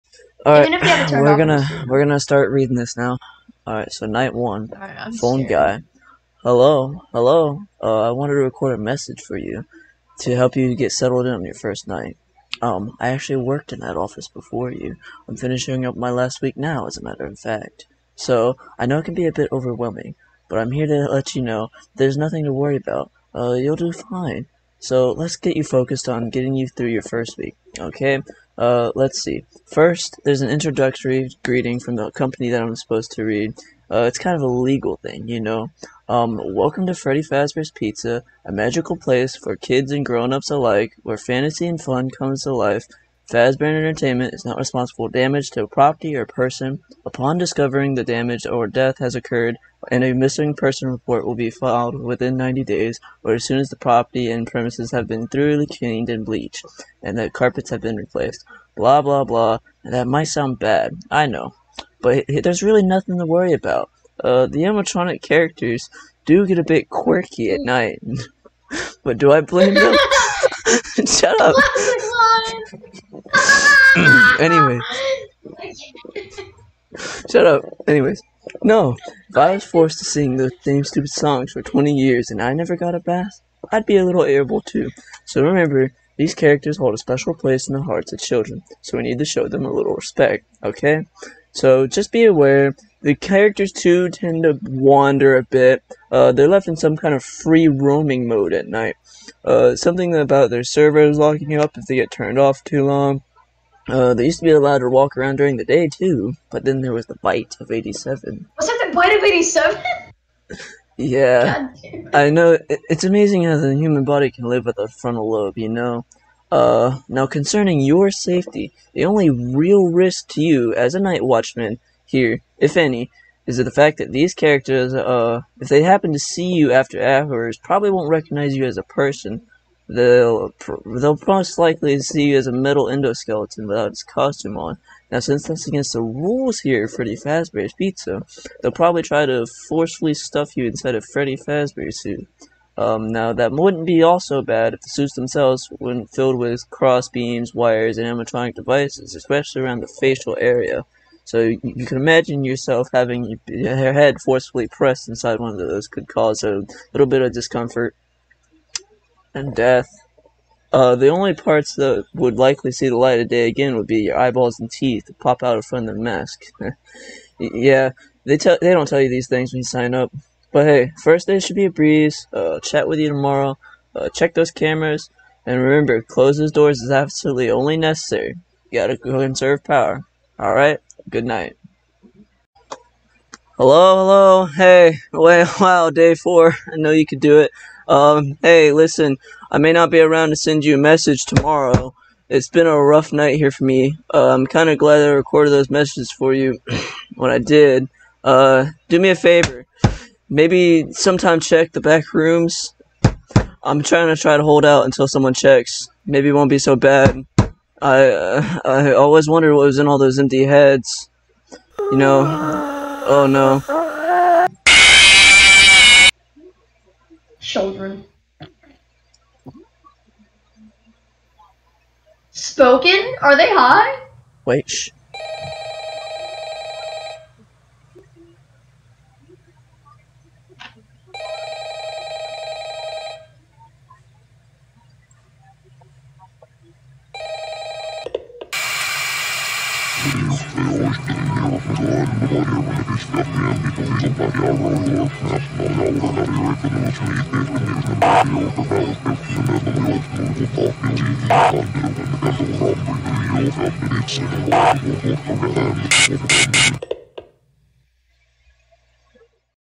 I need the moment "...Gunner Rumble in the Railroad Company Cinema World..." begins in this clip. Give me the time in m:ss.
4:15.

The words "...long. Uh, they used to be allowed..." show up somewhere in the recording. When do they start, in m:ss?
1:42.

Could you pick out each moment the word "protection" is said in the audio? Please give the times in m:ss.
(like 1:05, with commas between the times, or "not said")
not said.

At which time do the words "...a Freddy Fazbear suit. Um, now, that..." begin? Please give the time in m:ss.
2:20.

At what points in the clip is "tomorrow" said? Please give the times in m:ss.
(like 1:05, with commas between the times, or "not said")
2:53, 3:11.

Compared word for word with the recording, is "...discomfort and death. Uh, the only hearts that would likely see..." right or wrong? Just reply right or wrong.
wrong.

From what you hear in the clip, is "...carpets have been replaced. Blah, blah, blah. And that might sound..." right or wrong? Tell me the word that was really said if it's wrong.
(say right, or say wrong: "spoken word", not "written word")
right.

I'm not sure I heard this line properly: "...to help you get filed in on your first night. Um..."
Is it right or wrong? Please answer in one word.
wrong.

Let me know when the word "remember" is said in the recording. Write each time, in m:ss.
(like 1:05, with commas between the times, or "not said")
1:25, 2:55.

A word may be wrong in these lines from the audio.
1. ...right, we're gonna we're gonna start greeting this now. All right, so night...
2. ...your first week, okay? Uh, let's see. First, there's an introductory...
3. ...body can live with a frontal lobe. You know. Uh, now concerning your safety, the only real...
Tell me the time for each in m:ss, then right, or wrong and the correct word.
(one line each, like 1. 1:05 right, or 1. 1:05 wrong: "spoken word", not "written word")
1. 0:00 wrong: "reading", not "greeting"
2. 0:26 right
3. 1:54 right.